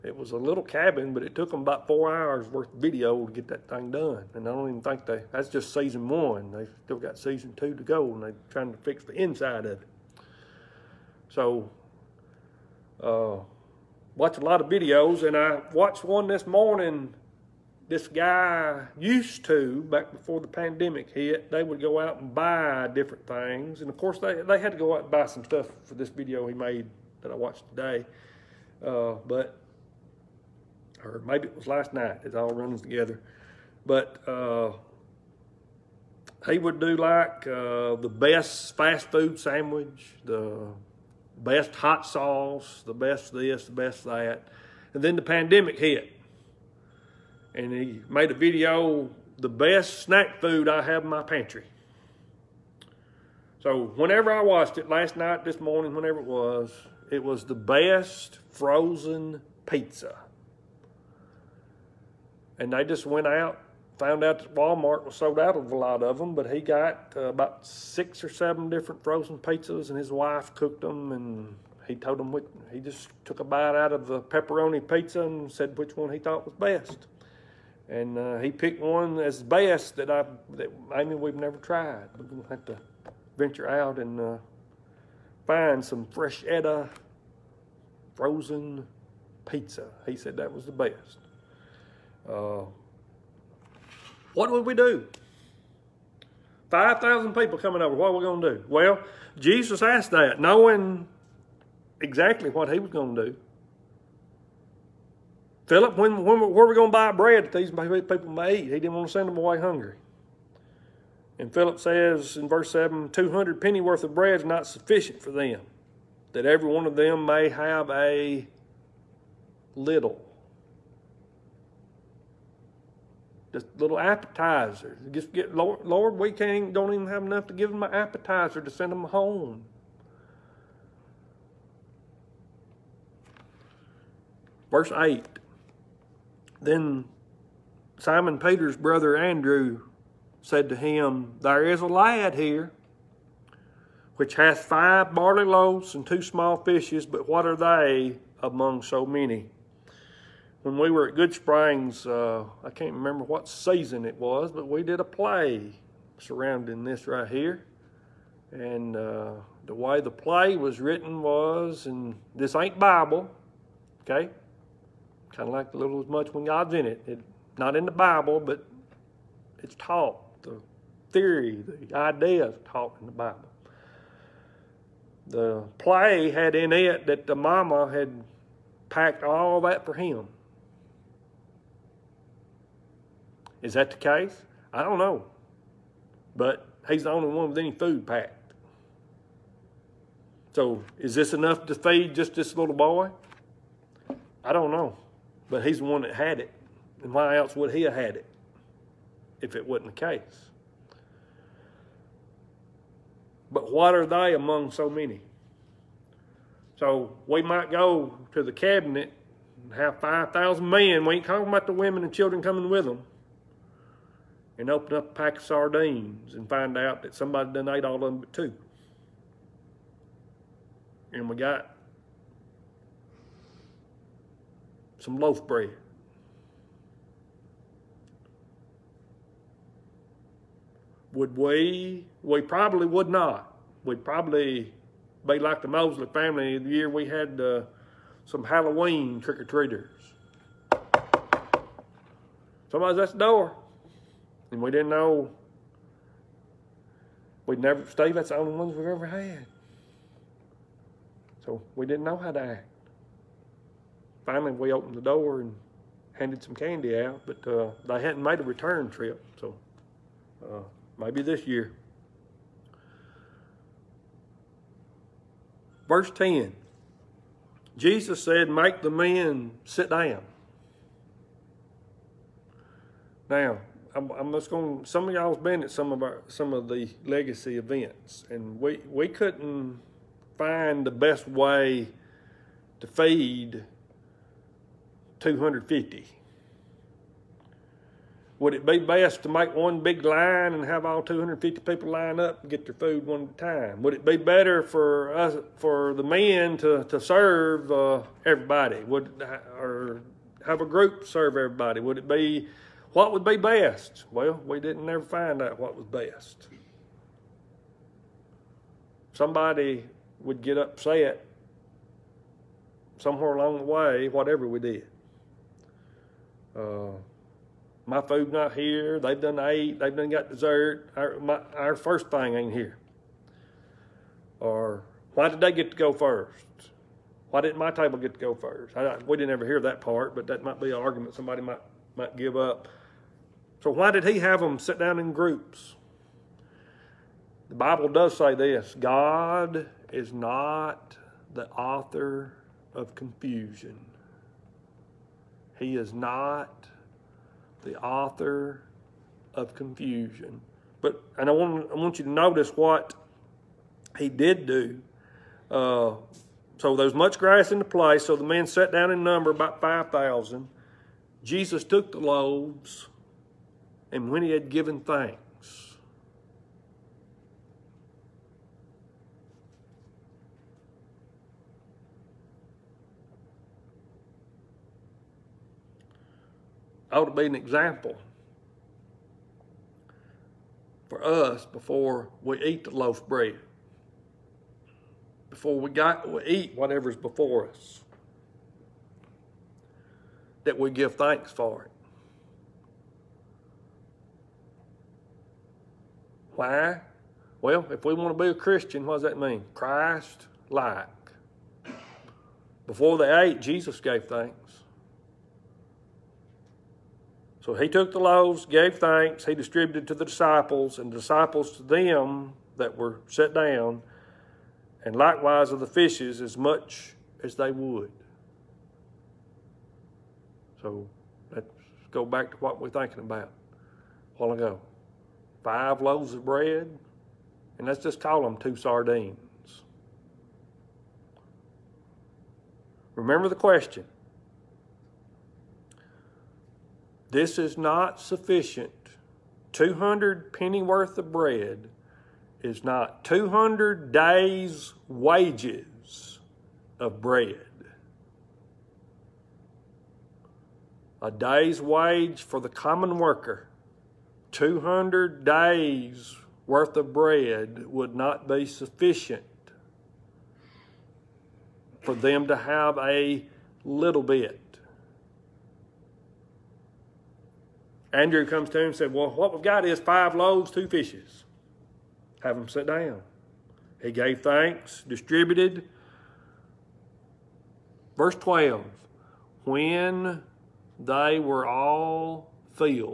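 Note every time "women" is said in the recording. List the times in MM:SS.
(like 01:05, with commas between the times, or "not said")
03:31.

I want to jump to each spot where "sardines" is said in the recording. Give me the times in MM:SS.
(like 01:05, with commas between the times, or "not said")
03:35, 07:08.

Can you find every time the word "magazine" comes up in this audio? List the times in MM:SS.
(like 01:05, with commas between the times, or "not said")
not said.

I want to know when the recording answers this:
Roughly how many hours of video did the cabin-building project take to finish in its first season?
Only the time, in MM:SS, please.
00:01.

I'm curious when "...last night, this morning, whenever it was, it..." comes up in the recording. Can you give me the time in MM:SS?
00:54.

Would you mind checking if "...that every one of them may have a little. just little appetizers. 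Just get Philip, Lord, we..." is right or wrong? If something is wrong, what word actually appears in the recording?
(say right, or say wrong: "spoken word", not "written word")
wrong: "Lord", not "Philip".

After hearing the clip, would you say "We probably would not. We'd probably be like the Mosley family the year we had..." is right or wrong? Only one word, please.
right.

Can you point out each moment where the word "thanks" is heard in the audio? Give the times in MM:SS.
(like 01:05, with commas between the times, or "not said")
06:04, 06:30, 06:44, 06:48, 07:54.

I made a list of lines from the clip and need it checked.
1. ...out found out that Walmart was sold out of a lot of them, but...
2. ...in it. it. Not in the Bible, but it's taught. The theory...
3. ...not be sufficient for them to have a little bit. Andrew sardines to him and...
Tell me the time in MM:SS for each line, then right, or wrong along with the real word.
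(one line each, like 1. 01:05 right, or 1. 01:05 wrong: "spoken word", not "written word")
1. 01:03 right
2. 02:46 right
3. 07:37 wrong: "comes", not "sardines".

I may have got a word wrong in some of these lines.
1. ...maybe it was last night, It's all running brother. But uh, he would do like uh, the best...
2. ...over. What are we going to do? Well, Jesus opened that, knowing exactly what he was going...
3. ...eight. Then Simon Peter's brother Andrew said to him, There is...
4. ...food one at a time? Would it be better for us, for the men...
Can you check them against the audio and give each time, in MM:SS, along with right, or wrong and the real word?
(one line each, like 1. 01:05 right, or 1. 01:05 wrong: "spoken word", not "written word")
1. 00:31 wrong: "together", not "brother"
2. 01:37 wrong: "asked", not "opened"
3. 02:14 right
4. 04:52 right.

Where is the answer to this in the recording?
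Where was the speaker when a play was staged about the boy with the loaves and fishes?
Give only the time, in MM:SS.
02:31.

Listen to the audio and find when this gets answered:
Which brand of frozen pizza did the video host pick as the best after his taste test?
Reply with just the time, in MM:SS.
01:26.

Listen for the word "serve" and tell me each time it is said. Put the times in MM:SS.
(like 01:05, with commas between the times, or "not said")
04:57, 05:01.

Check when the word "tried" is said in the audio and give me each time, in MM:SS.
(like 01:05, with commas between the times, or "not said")
01:21.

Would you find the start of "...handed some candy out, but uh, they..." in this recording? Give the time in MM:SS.
04:16.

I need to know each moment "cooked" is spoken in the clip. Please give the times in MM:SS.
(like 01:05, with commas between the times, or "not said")
01:10.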